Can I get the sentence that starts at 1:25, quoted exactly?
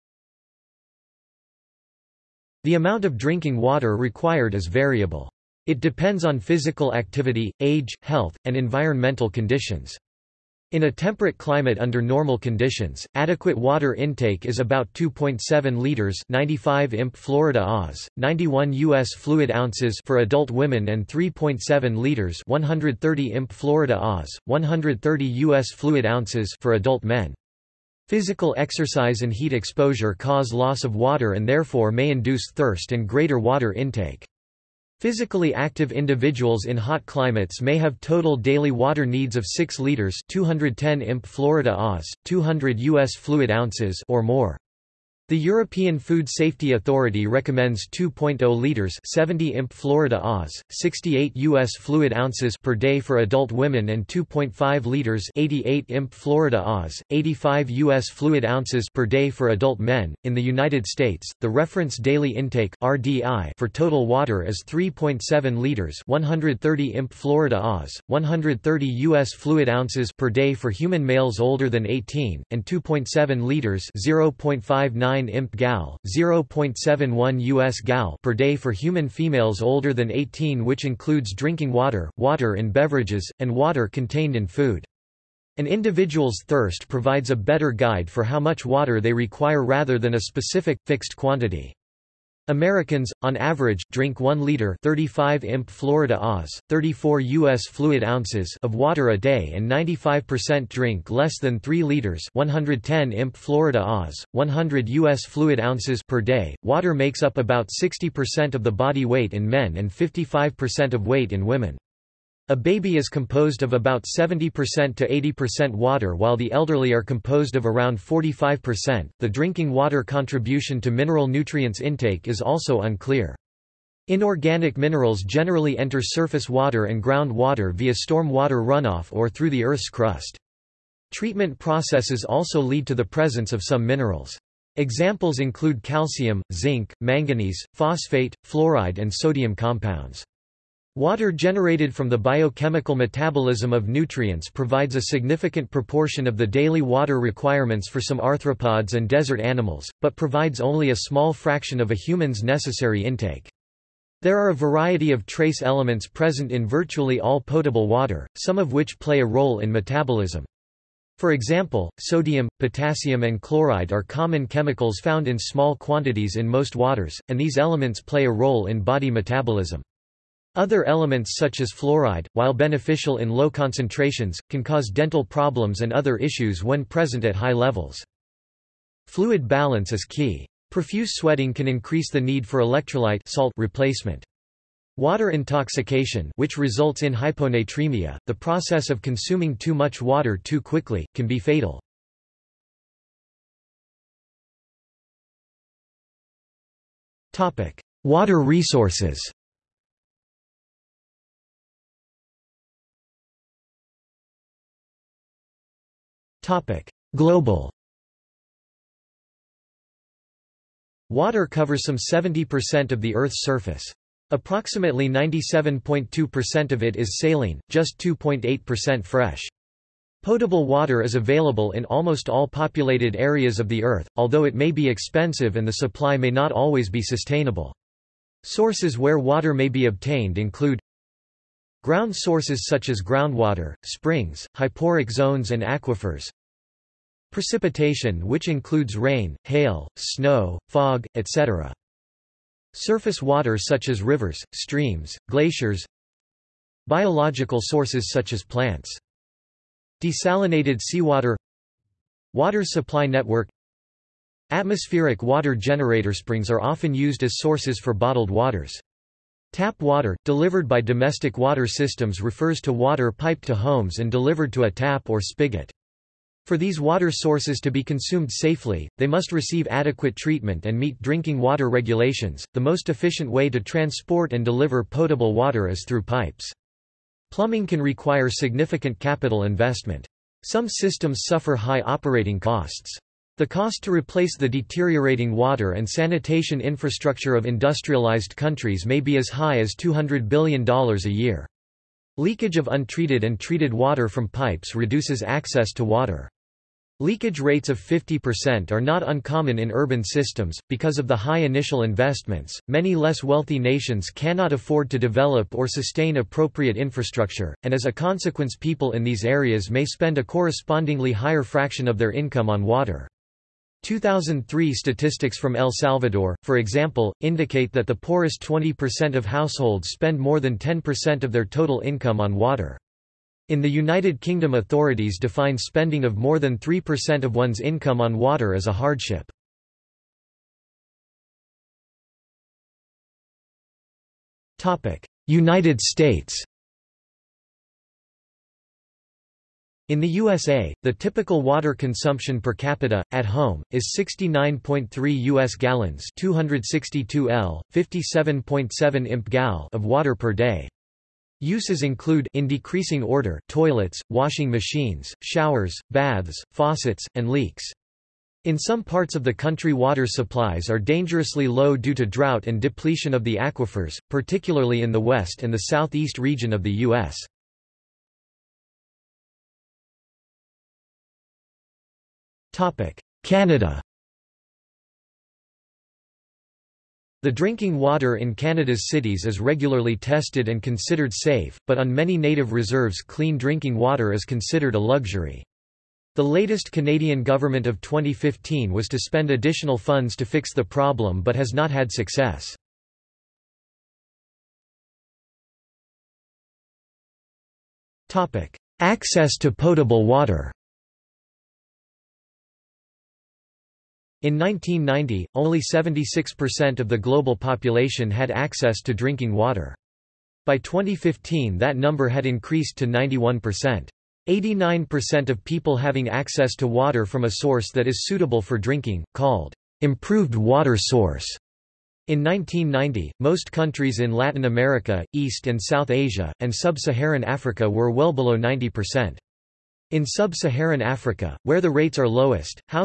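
An individual's thirst provides a better guide for how much water they require rather than a specific, fixed quantity.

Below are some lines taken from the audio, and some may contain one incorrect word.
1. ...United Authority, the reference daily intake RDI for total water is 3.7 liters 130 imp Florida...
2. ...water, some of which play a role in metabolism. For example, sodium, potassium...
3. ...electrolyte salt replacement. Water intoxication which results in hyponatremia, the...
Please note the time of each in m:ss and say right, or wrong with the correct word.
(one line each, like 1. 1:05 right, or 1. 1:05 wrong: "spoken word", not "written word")
1. 1:00 wrong: "States", not "Authority"
2. 2:37 right
3. 3:02 right.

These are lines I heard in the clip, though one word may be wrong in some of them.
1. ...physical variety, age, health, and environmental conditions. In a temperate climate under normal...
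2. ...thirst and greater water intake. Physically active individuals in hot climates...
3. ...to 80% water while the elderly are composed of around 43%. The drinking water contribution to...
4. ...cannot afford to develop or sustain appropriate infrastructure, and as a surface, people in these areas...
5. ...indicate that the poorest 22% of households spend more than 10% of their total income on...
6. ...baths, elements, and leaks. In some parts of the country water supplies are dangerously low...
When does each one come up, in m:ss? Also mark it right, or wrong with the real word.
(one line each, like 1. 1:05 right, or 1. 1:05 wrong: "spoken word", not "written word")
1. 0:06 wrong: "activity", not "variety"
2. 0:32 right
3. 1:54 wrong: "45", not "43"
4. 5:04 wrong: "consequence", not "surface"
5. 5:17 wrong: "20", not "22"
6. 5:55 wrong: "faucets", not "elements".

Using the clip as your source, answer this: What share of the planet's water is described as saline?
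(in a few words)
97.2%.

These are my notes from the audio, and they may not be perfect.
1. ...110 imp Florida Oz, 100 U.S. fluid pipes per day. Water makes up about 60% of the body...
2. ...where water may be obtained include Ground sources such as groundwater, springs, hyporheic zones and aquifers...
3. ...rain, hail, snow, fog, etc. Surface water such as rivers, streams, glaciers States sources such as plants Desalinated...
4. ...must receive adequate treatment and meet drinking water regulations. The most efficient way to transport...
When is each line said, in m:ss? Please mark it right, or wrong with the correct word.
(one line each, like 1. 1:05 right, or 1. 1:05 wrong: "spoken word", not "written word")
1. 1:42 wrong: "ounces", not "pipes"
2. 3:48 right
3. 3:58 wrong: "Biological", not "States"
4. 4:29 right.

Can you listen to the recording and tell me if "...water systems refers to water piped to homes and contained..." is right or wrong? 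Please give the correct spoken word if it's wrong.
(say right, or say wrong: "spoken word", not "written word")
wrong: "delivered", not "contained".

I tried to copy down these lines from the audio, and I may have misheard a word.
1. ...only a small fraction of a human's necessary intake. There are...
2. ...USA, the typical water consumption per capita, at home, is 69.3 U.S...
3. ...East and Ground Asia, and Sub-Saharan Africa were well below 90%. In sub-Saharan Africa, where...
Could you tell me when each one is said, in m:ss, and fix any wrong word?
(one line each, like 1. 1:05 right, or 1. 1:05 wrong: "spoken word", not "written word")
1. 2:30 right
2. 5:40 right
3. 7:05 wrong: "South", not "Ground".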